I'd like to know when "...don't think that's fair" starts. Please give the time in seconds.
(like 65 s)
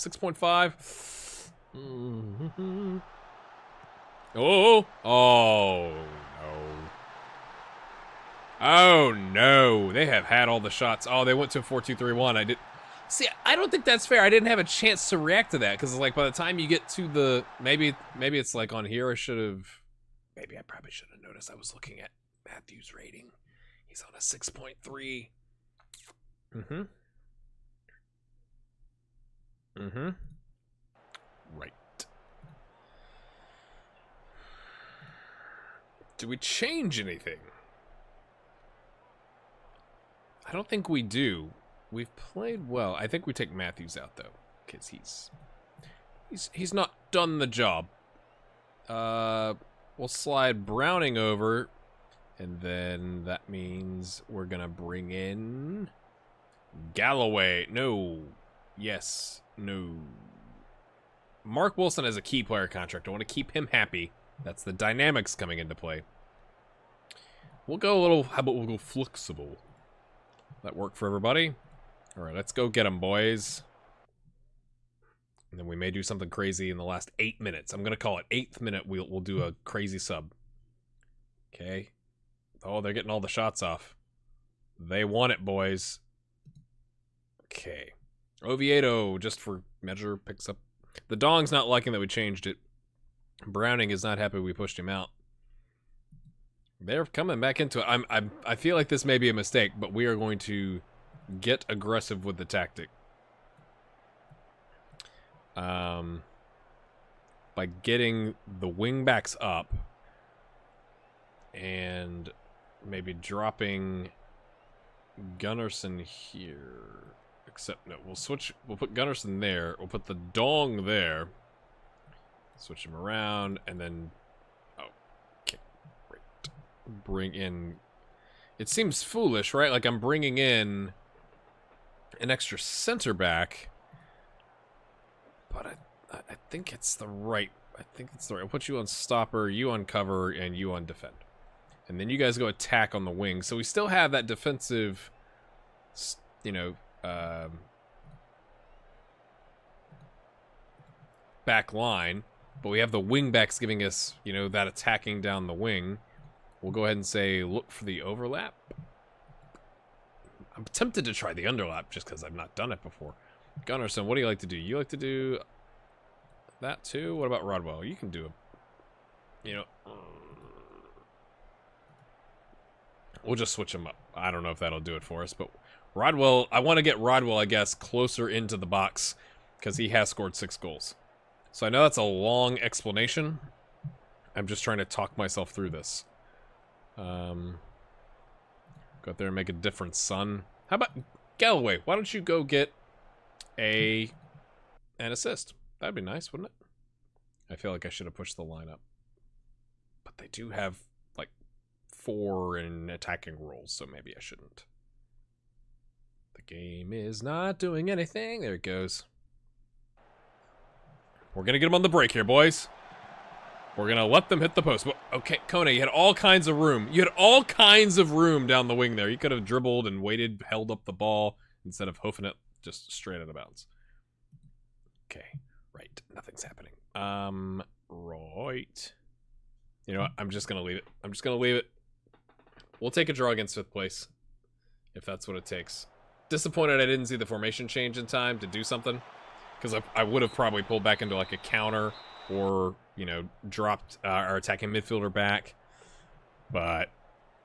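13 s.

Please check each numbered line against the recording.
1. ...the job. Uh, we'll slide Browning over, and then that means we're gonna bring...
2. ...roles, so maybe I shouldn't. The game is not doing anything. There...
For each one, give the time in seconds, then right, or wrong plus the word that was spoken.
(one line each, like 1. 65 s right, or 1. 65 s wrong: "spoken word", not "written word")
1. 47 s right
2. 203 s right.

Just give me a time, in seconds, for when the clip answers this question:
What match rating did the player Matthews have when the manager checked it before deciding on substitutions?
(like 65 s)
24 s.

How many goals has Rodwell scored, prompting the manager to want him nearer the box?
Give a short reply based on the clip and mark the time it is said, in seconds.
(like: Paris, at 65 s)
6, at 180 s.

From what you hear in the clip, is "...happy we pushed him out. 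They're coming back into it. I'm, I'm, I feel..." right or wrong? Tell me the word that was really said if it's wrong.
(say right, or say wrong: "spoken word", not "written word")
right.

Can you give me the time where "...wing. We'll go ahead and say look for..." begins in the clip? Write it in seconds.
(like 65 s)
155 s.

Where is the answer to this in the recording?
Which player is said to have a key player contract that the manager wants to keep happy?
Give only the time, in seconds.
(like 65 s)
61 s.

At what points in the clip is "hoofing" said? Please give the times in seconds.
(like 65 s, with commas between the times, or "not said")
221 s.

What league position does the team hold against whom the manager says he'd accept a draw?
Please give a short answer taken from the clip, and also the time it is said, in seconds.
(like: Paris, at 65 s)
Fifth place, at 233 s.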